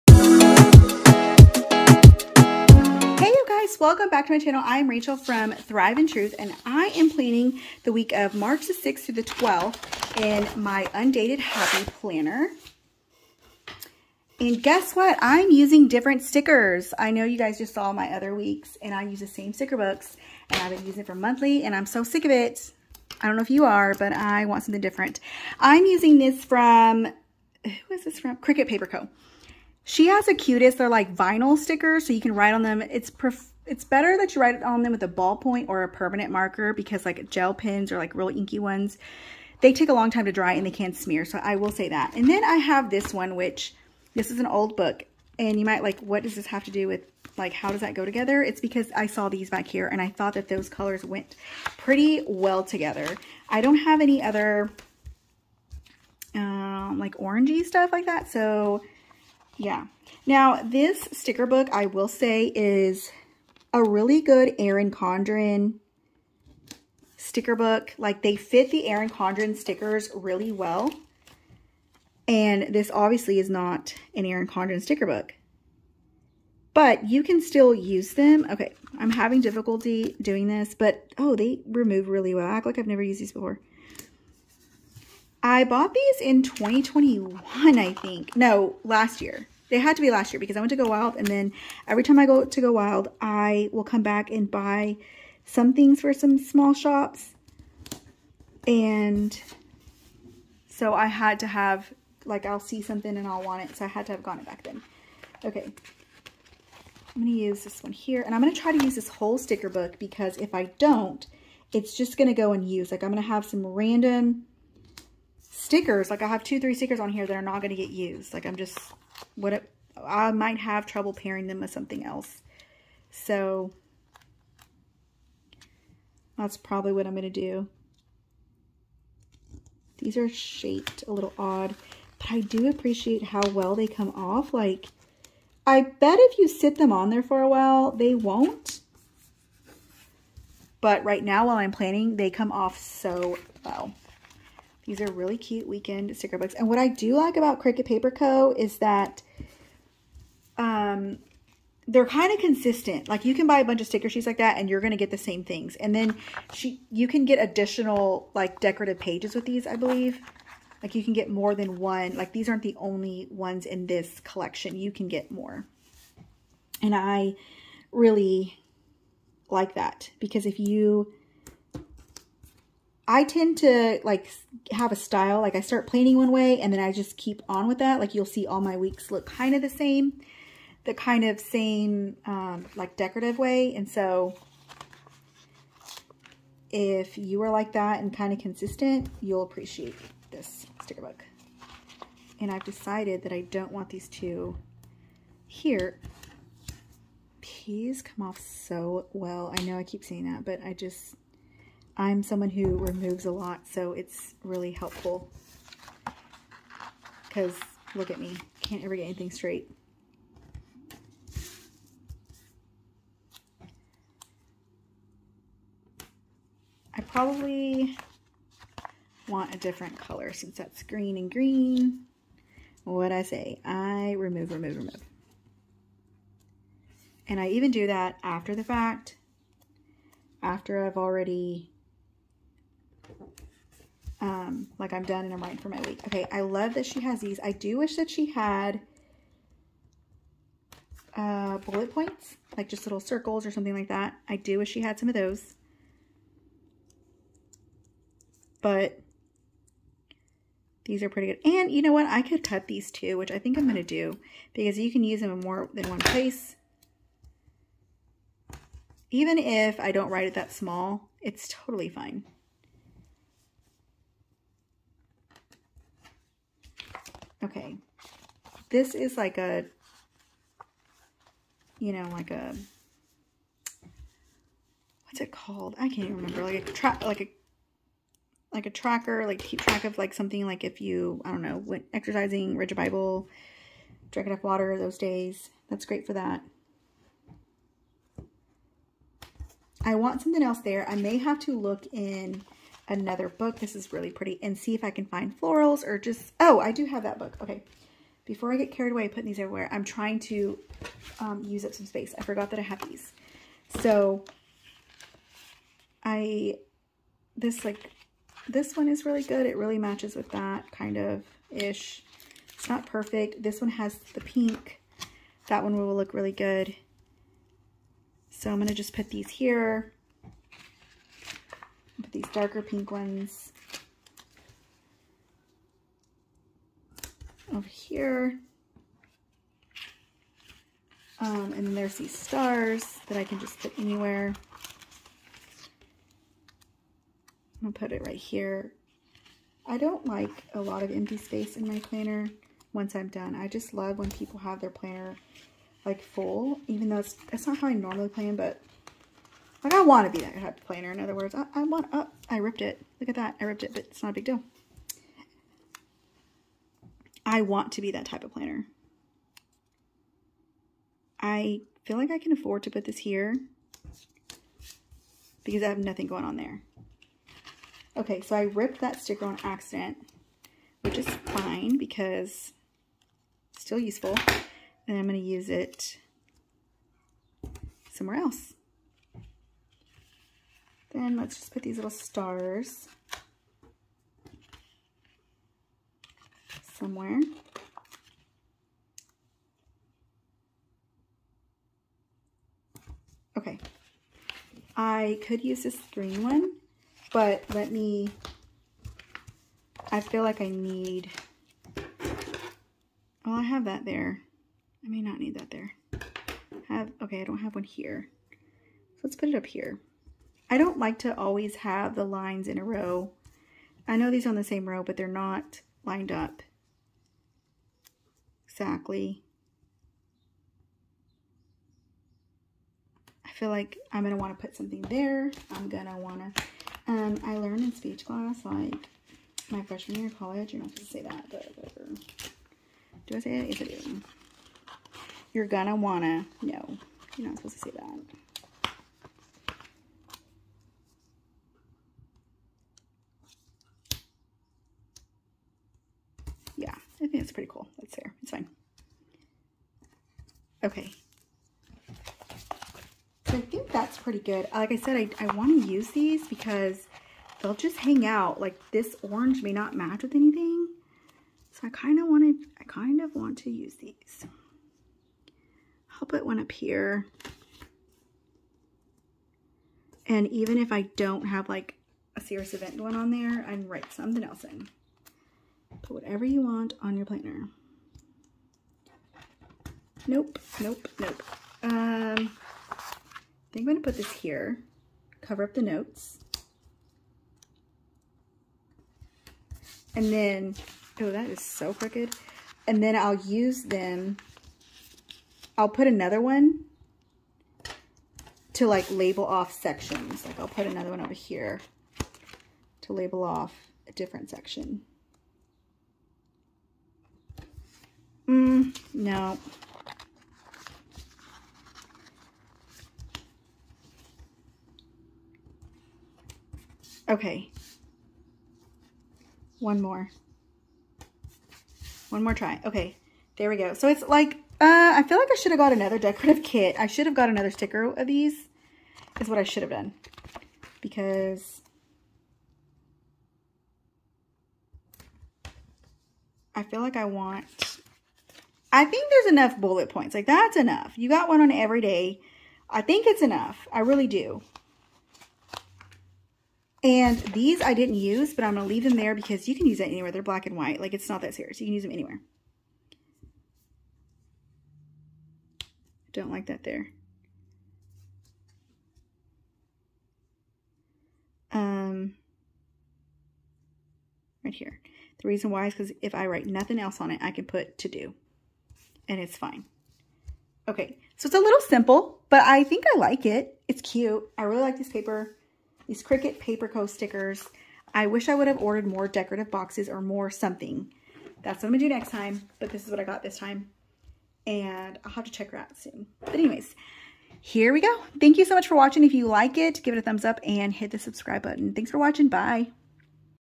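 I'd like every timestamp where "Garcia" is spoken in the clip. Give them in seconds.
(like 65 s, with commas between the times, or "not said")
not said.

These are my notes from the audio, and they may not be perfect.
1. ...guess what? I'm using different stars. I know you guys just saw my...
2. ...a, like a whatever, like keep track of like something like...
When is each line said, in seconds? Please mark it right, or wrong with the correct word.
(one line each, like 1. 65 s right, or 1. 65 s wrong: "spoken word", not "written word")
1. 14 s wrong: "stickers", not "stars"
2. 277 s wrong: "tracker", not "whatever".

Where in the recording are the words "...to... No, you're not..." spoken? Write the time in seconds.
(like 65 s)
436 s.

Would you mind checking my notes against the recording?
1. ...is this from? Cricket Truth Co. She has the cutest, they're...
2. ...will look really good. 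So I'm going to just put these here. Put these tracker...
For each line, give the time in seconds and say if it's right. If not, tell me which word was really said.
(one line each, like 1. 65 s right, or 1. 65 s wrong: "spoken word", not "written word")
1. 27 s wrong: "Paper", not "Truth"
2. 315 s wrong: "darker", not "tracker".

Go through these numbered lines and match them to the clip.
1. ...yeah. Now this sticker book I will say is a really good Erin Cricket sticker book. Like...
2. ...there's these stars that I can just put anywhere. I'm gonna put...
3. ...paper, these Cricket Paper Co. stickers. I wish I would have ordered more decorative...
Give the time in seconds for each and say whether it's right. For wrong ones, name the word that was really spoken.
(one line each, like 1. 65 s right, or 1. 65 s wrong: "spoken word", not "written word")
1. 59 s wrong: "Condren", not "Cricket"
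2. 331 s right
3. 574 s right.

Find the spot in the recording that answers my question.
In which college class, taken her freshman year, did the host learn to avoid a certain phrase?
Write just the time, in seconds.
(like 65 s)
427 s.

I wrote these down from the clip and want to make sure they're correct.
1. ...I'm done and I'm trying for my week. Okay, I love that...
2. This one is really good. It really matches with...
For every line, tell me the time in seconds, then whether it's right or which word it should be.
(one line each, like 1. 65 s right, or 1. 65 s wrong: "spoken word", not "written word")
1. 234 s wrong: "writing", not "trying"
2. 308 s right.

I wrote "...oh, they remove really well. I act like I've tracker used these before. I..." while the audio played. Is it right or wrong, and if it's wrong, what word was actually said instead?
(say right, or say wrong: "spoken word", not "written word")
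wrong: "never", not "tracker".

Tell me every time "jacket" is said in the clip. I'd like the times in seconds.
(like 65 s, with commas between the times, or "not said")
not said.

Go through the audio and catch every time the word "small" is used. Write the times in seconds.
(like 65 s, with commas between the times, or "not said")
96 s, 260 s.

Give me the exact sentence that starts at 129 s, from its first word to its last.
These are shaped a little odd, but I do appreciate how well they come off.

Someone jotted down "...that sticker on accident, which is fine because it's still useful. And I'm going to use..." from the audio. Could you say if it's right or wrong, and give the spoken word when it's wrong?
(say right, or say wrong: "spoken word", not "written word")
right.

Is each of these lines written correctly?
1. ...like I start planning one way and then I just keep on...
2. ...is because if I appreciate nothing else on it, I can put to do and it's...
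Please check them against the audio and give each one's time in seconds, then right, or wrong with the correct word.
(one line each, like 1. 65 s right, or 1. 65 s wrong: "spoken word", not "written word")
1. 175 s right
2. 565 s wrong: "write", not "appreciate".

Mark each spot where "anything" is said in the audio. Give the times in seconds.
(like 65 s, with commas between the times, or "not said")
209 s, 460 s.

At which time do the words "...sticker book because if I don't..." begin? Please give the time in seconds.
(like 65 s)
109 s.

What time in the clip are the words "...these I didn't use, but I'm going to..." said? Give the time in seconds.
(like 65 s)
547 s.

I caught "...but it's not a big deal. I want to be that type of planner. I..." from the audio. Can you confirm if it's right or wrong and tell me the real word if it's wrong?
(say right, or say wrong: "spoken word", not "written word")
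right.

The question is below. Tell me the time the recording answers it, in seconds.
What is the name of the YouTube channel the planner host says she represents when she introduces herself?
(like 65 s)
5 s.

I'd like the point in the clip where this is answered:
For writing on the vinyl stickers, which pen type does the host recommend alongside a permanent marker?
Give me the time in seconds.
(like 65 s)
35 s.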